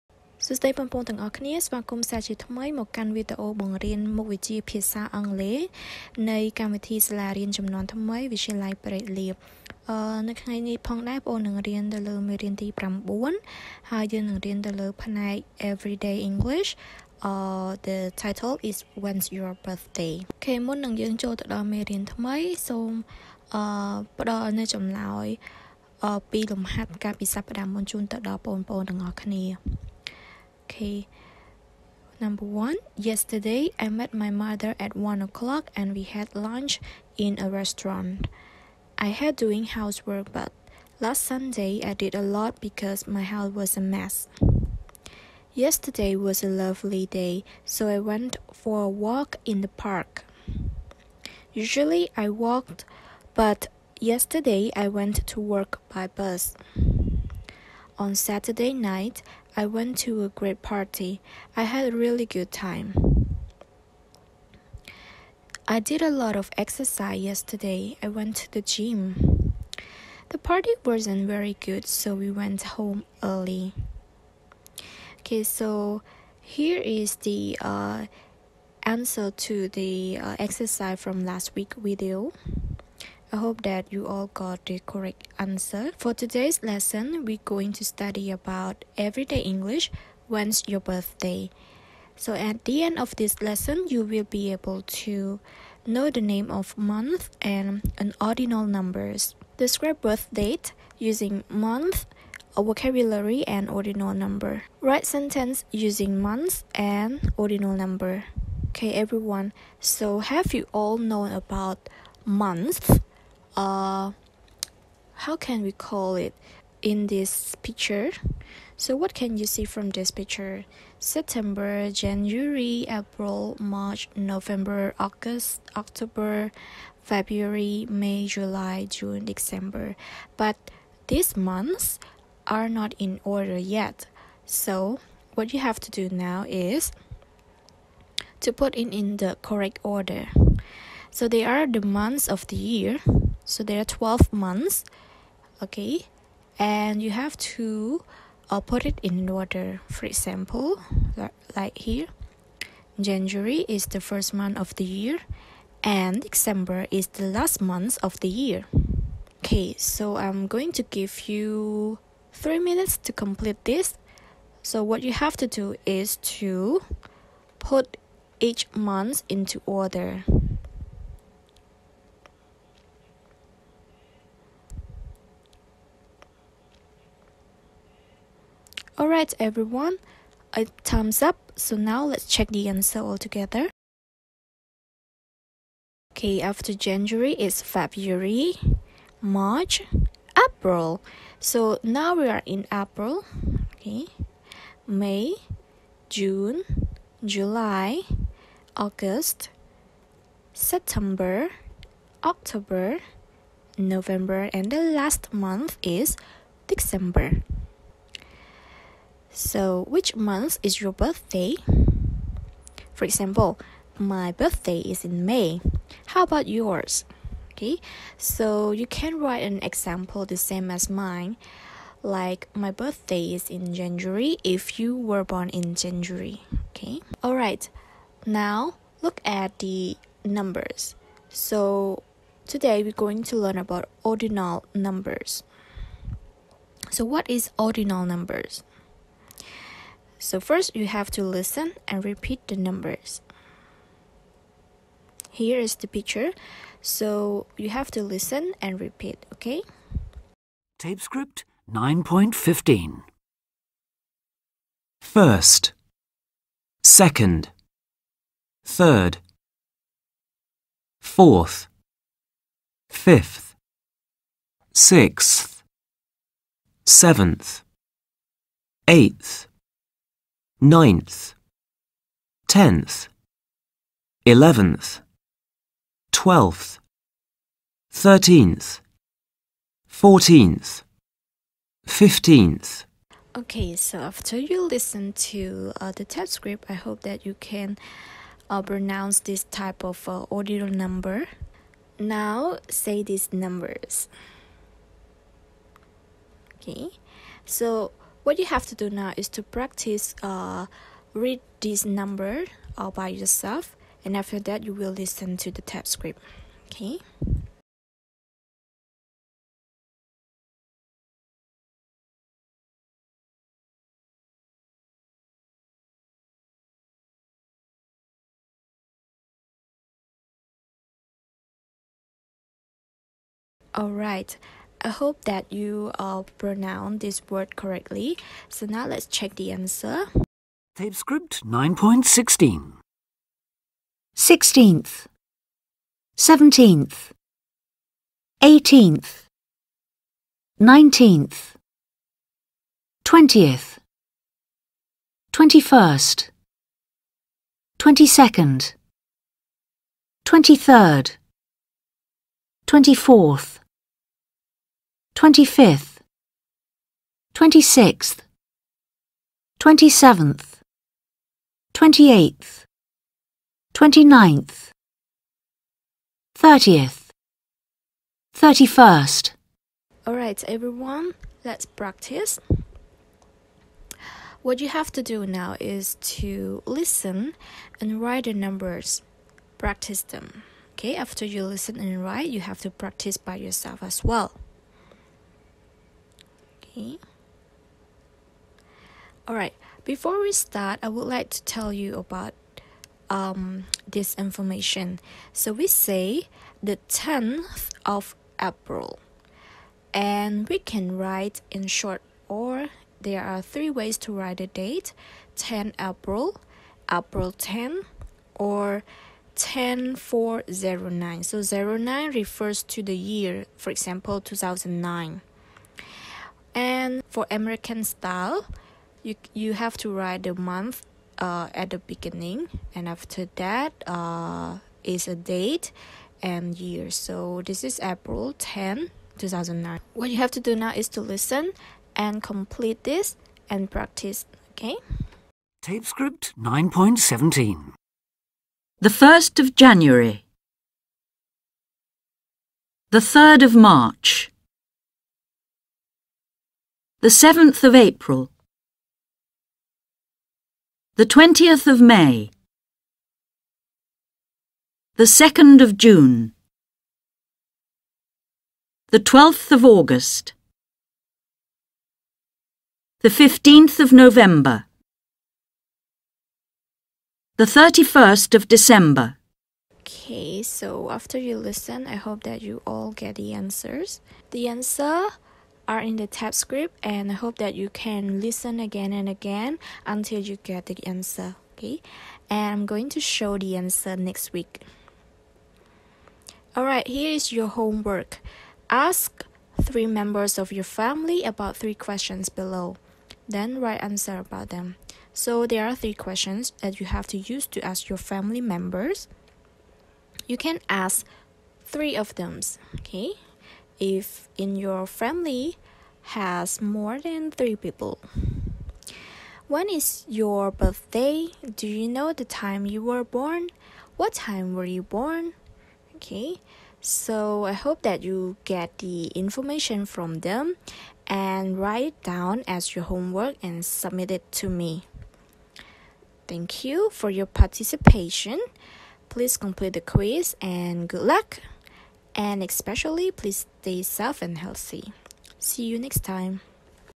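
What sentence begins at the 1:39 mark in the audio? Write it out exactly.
Describe birth date using month, a vocabulary and ordinal number.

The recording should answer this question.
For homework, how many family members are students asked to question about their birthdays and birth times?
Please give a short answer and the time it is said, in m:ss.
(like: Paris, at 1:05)
3, at 8:09.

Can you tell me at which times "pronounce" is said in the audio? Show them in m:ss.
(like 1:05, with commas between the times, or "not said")
4:48, 5:26.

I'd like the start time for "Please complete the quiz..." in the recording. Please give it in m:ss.
8:49.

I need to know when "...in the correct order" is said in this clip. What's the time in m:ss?
2:18.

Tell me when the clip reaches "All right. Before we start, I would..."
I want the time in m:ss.
6:29.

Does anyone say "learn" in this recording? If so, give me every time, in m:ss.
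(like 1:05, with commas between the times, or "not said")
3:53.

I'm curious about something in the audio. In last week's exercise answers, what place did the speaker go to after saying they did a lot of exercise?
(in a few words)
the gym.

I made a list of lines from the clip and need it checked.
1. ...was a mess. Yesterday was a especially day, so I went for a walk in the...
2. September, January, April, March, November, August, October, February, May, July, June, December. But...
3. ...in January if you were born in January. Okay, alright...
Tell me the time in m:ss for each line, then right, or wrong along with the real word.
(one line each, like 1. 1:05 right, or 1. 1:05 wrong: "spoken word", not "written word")
1. 0:43 wrong: "lovely", not "especially"
2. 2:00 right
3. 3:43 right.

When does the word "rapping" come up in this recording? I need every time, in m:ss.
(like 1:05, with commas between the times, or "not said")
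not said.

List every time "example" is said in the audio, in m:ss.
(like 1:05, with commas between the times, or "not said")
2:30, 3:33, 3:39, 6:53.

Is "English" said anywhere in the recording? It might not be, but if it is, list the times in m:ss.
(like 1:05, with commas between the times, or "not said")
0:16, 1:29.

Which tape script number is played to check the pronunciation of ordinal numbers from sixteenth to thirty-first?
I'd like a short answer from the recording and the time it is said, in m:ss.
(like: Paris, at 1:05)
9.16, at 5:30.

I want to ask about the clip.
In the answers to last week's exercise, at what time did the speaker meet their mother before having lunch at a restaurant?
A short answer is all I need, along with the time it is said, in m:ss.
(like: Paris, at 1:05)
1 o'clock, at 0:34.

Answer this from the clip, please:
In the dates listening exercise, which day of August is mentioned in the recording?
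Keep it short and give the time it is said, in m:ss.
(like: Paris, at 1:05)
12th, at 7:38.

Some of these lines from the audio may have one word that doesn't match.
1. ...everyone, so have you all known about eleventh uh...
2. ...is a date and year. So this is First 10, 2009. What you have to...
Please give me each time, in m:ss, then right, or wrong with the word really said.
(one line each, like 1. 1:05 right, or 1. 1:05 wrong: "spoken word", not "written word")
1. 1:48 wrong: "month", not "eleventh"
2. 7:04 wrong: "April", not "First".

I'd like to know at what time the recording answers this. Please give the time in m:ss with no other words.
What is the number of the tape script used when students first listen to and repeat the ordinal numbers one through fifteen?
4:10.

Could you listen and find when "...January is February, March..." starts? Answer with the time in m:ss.
3:06.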